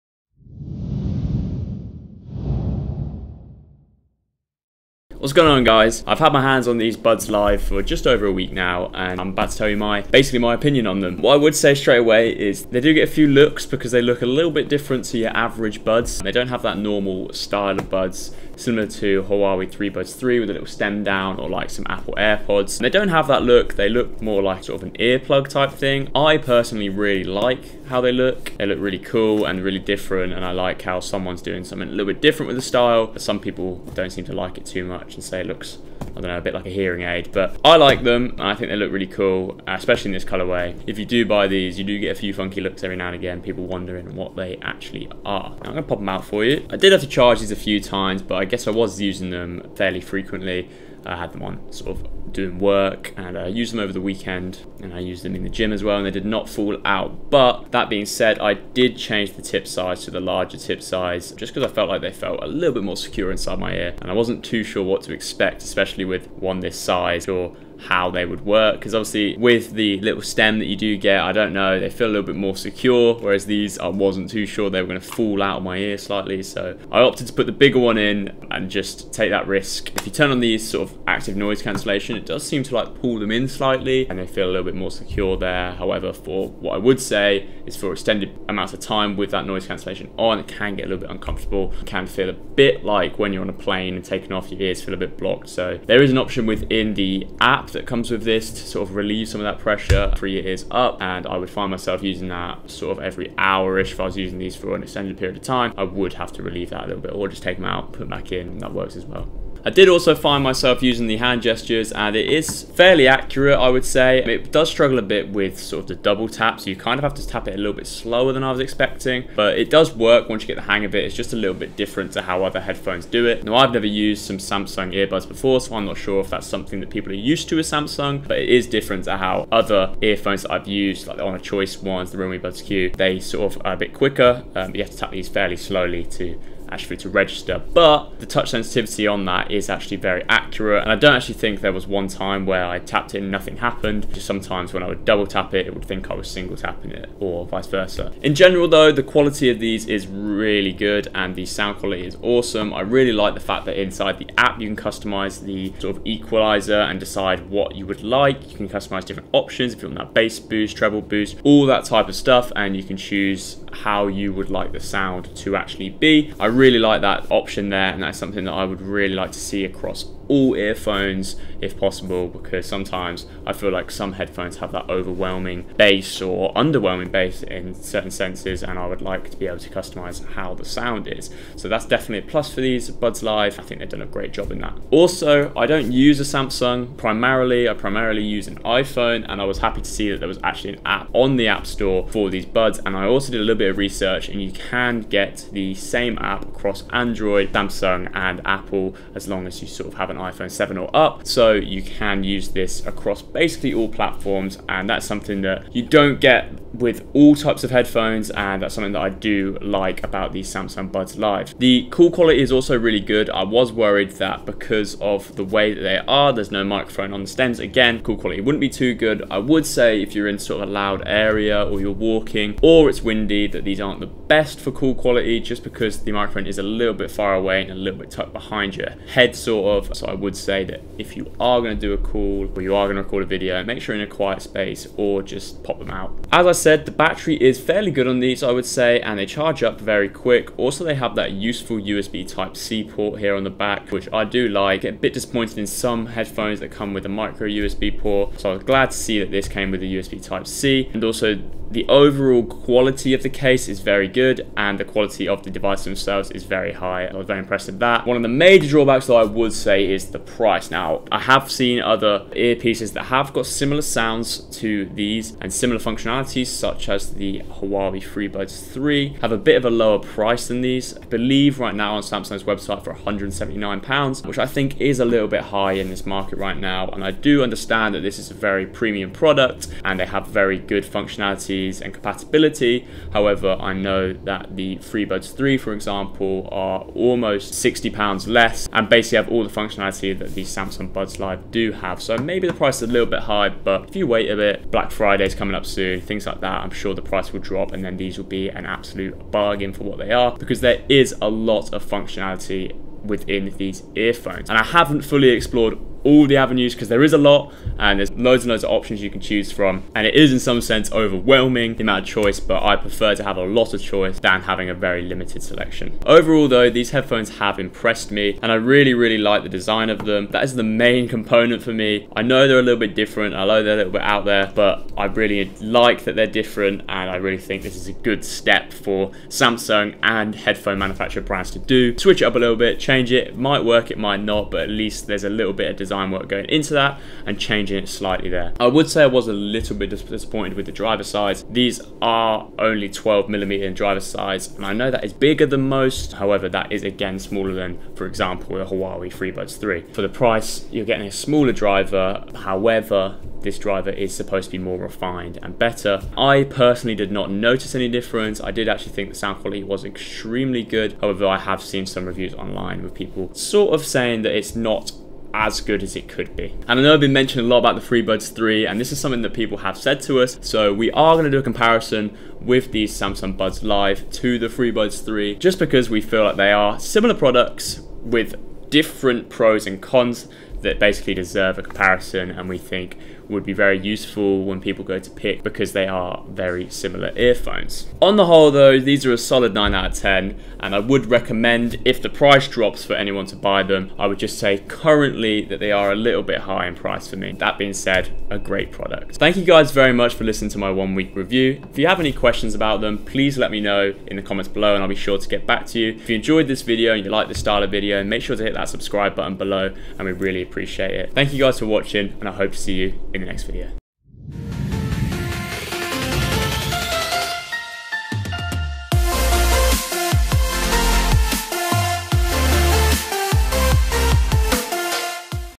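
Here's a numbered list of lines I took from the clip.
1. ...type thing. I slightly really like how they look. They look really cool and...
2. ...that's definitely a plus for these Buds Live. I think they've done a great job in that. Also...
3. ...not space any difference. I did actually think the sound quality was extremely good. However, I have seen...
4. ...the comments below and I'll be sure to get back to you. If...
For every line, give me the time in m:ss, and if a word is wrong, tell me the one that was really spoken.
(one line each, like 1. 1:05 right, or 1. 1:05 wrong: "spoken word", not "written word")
1. 0:25 wrong: "personally", not "slightly"
2. 3:01 right
3. 5:57 wrong: "notice", not "space"
4. 6:44 right.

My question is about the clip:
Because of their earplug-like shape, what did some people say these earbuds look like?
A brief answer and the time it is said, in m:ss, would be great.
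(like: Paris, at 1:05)
a hearing aid, at 0:36.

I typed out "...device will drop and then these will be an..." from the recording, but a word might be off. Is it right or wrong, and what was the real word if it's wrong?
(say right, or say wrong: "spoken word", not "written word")
wrong: "price", not "device".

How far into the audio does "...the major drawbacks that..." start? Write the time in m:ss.
4:18.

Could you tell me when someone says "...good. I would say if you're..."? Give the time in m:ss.
3:38.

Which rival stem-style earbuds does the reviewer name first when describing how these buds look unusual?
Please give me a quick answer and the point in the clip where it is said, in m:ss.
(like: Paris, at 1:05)
Huawei Buds 3, at 0:19.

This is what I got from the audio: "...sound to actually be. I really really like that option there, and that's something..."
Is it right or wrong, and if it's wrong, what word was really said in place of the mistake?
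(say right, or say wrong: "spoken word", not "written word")
right.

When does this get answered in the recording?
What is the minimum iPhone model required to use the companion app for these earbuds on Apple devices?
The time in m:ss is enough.
3:20.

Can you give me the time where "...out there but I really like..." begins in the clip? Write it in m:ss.
5:24.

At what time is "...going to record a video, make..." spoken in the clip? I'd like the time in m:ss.
3:52.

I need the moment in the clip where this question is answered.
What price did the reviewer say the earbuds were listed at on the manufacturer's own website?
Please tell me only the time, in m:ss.
4:32.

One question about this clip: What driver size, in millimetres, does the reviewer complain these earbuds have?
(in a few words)
12 millimeter.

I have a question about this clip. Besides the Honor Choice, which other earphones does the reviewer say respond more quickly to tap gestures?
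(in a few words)
Realme Buds Q.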